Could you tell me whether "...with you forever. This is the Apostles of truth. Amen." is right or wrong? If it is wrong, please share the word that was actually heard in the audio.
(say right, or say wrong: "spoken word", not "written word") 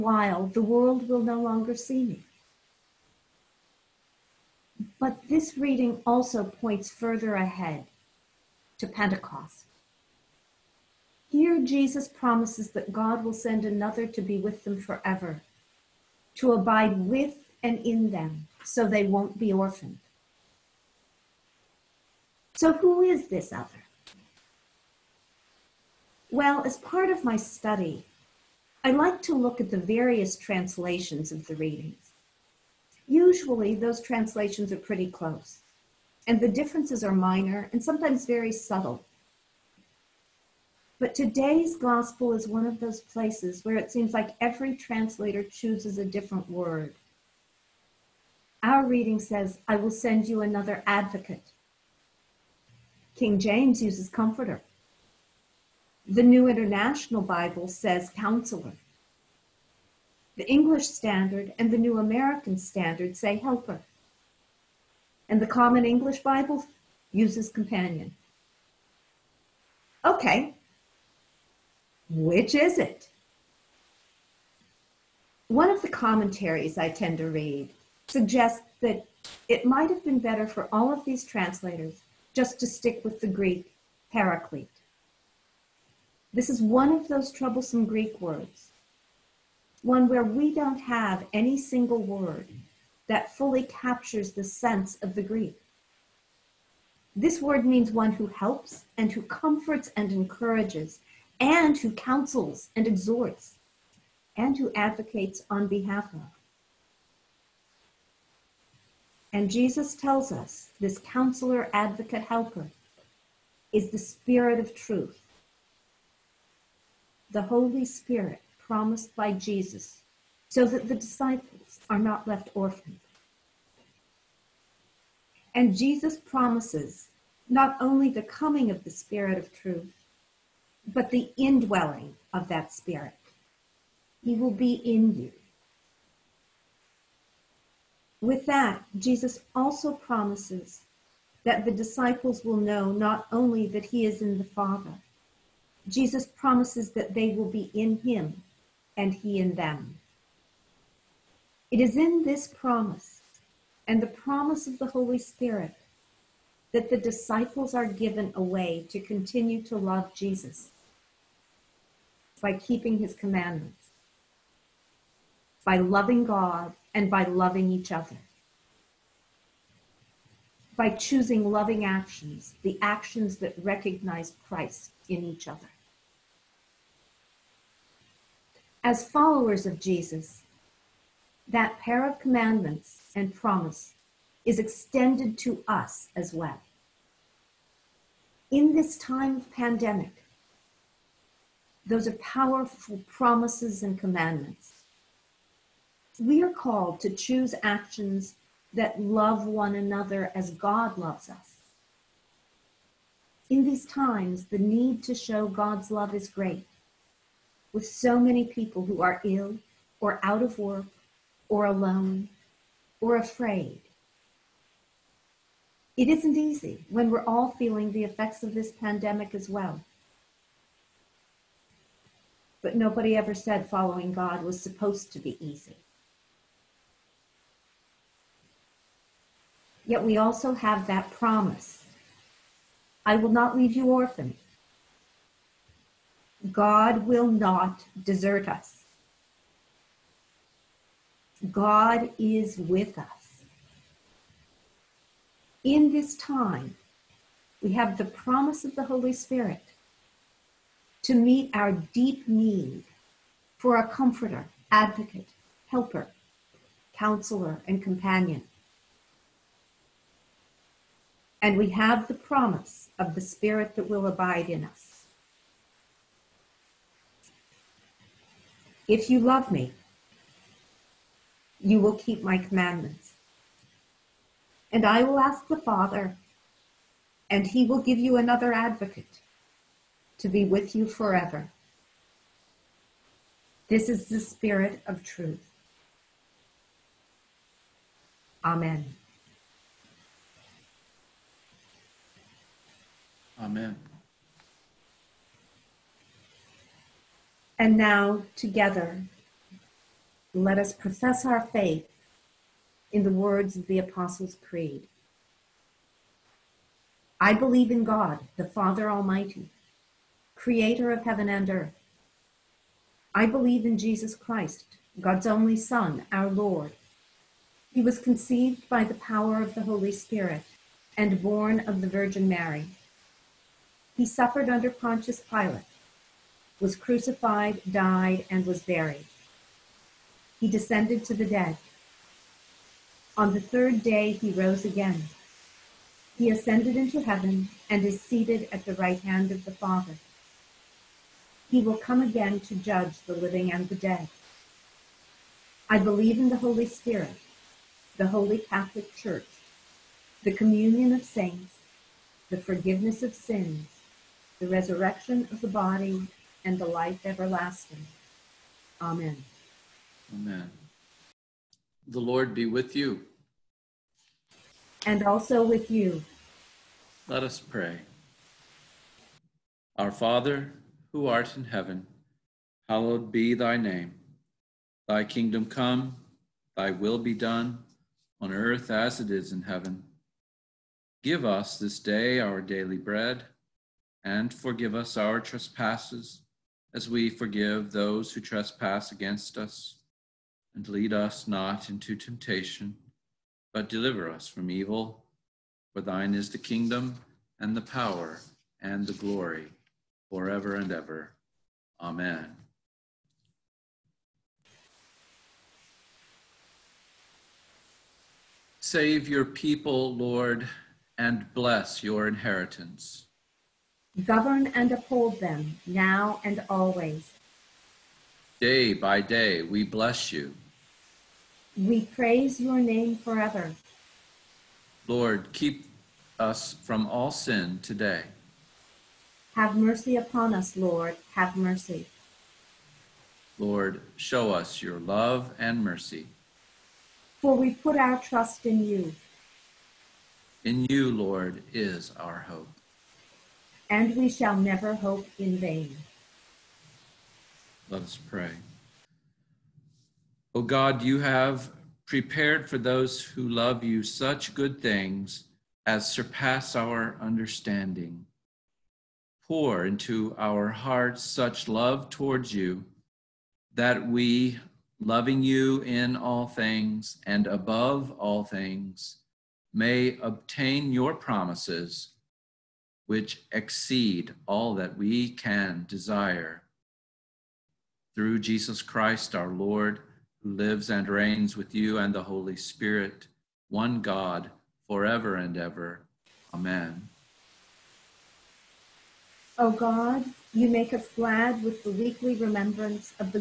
wrong: "Spirit", not "Apostles".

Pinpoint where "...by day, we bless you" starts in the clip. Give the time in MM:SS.
06:58.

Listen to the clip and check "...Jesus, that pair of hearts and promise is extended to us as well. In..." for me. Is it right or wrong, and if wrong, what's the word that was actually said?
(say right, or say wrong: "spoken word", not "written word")
wrong: "commandments", not "hearts".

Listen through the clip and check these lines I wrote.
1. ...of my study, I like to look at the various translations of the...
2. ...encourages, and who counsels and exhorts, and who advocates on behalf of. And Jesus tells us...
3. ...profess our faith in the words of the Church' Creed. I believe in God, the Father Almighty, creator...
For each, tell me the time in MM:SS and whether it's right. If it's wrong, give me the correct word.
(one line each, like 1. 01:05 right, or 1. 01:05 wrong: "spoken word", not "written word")
1. 00:27 right
2. 01:40 right
3. 05:00 wrong: "Apostles", not "Church".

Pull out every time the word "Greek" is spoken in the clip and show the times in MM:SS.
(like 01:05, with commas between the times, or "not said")
01:23, 01:27, 01:35.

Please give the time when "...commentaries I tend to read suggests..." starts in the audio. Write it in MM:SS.
01:16.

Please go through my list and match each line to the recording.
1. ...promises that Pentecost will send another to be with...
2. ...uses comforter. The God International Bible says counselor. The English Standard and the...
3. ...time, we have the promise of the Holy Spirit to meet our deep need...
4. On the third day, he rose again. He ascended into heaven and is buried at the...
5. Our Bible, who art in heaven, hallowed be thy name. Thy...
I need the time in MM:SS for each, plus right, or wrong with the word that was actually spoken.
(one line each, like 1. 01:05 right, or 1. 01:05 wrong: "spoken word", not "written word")
1. 00:12 wrong: "God", not "Pentecost"
2. 00:53 wrong: "New", not "God"
3. 04:06 right
4. 05:33 wrong: "seated", not "buried"
5. 06:09 wrong: "Father", not "Bible".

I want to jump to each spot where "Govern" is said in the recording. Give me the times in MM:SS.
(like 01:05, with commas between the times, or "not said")
06:54.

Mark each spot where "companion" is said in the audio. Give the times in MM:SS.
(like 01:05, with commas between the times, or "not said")
01:07, 04:17.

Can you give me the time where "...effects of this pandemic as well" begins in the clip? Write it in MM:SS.
03:38.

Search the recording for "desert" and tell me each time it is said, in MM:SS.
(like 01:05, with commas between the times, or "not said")
03:58.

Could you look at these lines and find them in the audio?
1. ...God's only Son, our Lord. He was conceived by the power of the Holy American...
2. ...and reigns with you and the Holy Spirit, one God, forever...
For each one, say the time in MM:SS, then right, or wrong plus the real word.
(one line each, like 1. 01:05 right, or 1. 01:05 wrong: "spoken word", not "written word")
1. 05:14 wrong: "Spirit", not "American"
2. 08:00 right.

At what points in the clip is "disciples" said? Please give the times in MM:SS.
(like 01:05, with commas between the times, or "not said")
02:00, 02:21, 02:36.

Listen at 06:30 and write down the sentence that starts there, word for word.
And lead us not into temptation, but deliver us from evil.